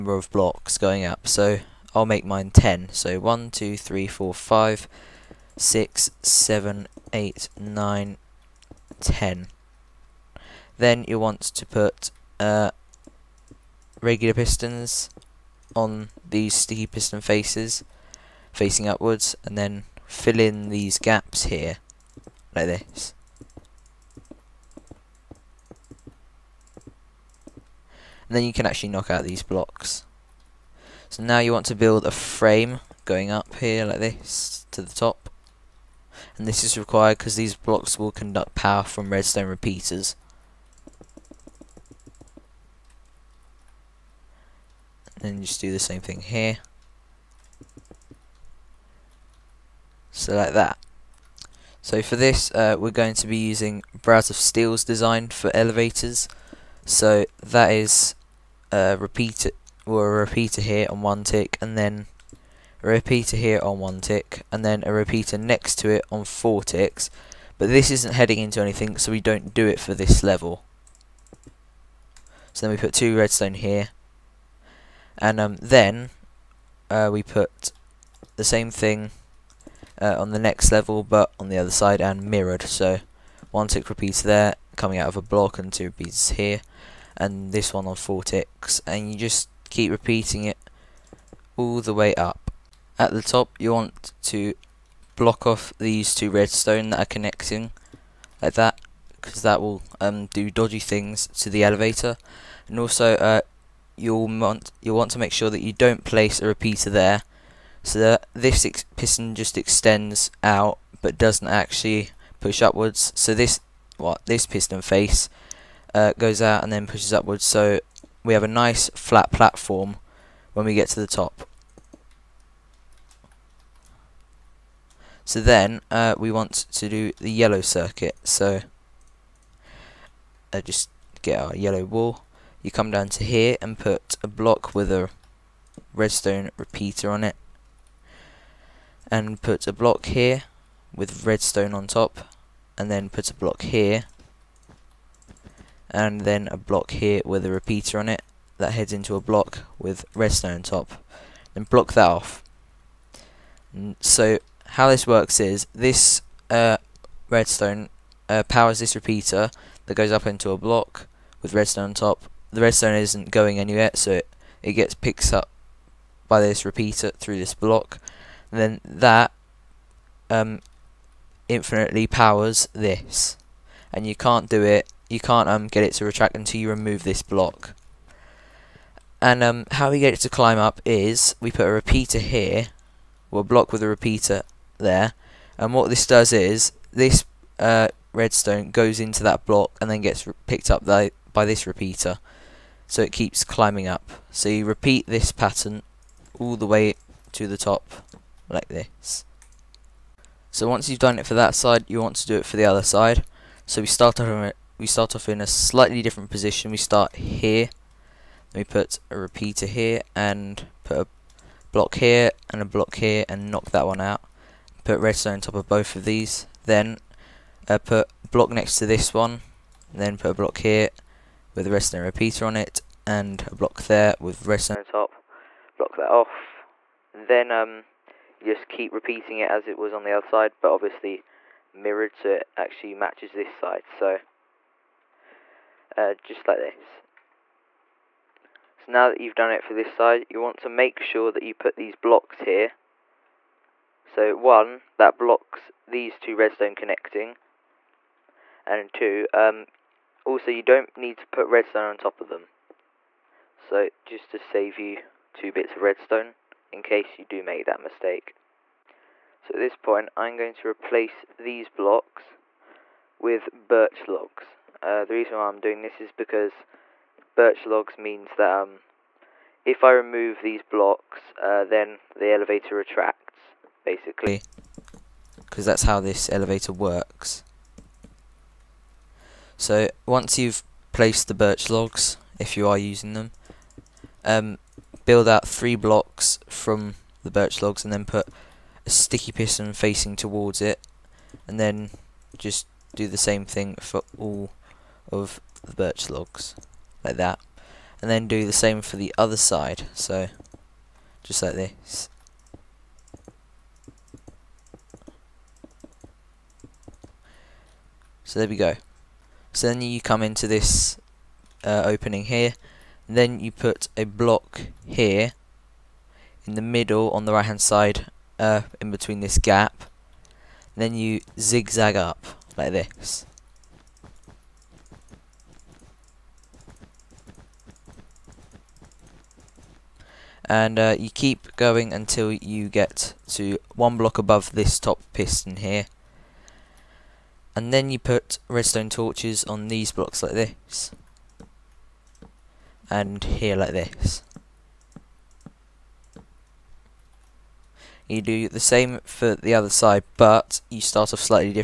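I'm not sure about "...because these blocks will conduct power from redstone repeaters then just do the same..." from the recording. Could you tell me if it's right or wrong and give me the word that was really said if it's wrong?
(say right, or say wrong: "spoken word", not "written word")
right.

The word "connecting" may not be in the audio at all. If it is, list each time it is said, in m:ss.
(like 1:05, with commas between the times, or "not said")
1:37, 4:06.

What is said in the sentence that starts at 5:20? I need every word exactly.
Then you zigzag up like this.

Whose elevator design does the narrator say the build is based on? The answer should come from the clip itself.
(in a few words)
Brass of Steel.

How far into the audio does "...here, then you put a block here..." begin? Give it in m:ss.
5:12.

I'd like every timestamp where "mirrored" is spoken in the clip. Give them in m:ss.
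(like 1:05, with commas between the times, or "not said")
1:22, 3:51.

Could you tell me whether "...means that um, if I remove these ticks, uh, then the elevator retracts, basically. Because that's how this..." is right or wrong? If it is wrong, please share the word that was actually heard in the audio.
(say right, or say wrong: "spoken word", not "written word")
wrong: "blocks", not "ticks".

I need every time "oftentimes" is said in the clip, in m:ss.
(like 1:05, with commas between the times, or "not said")
not said.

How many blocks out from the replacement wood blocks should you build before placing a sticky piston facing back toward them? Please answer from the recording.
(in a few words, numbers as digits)
3.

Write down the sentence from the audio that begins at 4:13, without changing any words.
So, just to save you two bits of redstone, in case you do make that mistake.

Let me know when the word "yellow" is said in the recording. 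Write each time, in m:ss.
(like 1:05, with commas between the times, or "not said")
2:07, 2:11.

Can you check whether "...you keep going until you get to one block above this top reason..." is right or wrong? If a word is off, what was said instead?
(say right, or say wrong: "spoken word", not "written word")
wrong: "piston", not "reason".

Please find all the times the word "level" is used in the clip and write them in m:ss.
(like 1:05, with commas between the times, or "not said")
1:10, 1:20.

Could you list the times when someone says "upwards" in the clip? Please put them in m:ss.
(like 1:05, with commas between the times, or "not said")
0:18, 1:52, 1:57.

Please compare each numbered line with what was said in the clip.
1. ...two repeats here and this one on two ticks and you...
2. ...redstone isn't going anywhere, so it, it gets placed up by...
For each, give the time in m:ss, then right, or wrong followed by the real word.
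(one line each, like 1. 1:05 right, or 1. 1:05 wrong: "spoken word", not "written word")
1. 1:25 wrong: "four", not "two"
2. 2:42 wrong: "picked", not "placed".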